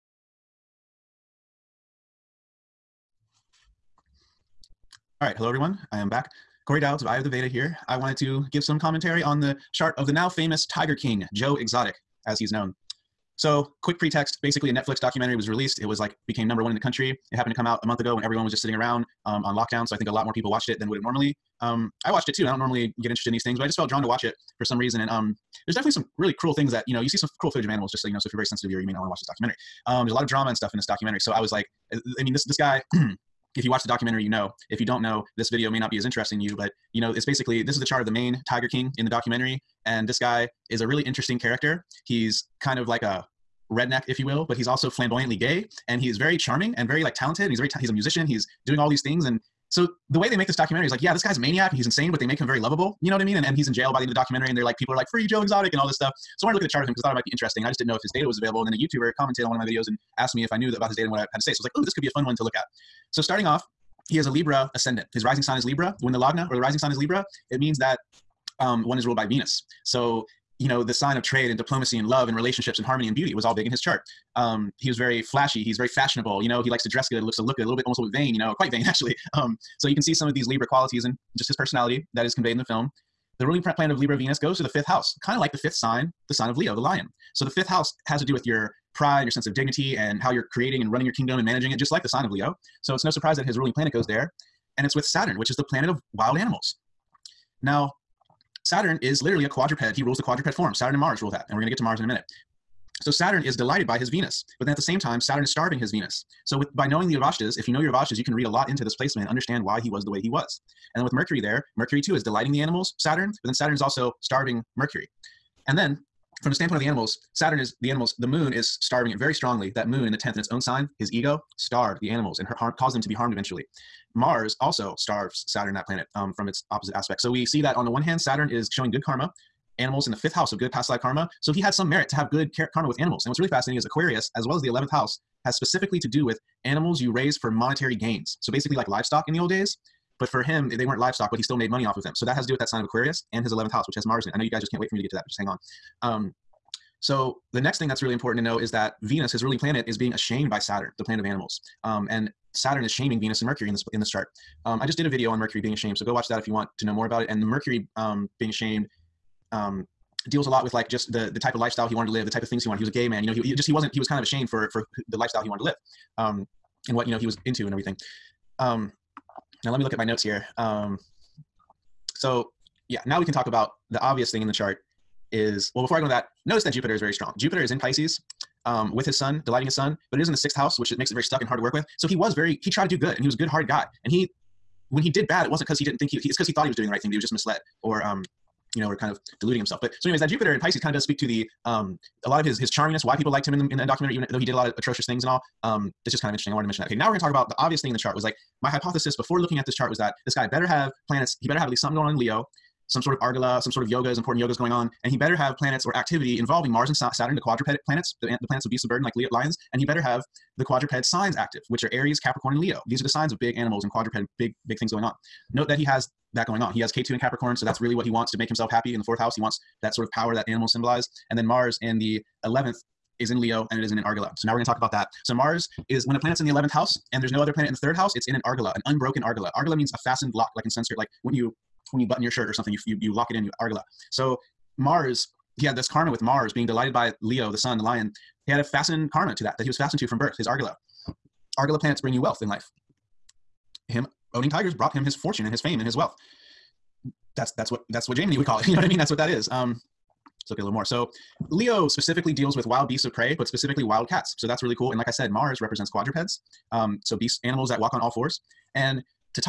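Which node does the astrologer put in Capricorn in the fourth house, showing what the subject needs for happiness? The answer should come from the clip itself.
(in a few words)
Ketu.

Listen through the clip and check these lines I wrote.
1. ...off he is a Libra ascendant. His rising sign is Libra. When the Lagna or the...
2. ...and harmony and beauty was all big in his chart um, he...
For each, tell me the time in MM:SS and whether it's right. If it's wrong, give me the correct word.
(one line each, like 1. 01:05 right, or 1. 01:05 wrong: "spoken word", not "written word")
1. 01:03 right
2. 01:12 right.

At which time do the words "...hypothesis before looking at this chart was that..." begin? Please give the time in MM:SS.
03:18.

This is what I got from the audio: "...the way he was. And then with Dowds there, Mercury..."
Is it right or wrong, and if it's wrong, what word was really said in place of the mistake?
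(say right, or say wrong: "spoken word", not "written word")
wrong: "Mercury", not "Dowds".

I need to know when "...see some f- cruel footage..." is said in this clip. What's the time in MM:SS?
00:27.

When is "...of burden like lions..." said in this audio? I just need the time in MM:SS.
03:28.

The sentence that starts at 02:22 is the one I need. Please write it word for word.
So that has to do with that sign of Aquarius and his 11th house, which has Mars in it.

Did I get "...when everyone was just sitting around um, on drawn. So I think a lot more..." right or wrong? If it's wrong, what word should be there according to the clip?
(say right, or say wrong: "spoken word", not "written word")
wrong: "lockdown", not "drawn".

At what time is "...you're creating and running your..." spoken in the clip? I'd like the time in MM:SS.
01:30.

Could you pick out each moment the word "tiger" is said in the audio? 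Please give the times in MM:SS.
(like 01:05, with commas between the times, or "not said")
00:10, 00:38, 04:04.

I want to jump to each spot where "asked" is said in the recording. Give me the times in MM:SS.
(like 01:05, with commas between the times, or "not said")
01:00.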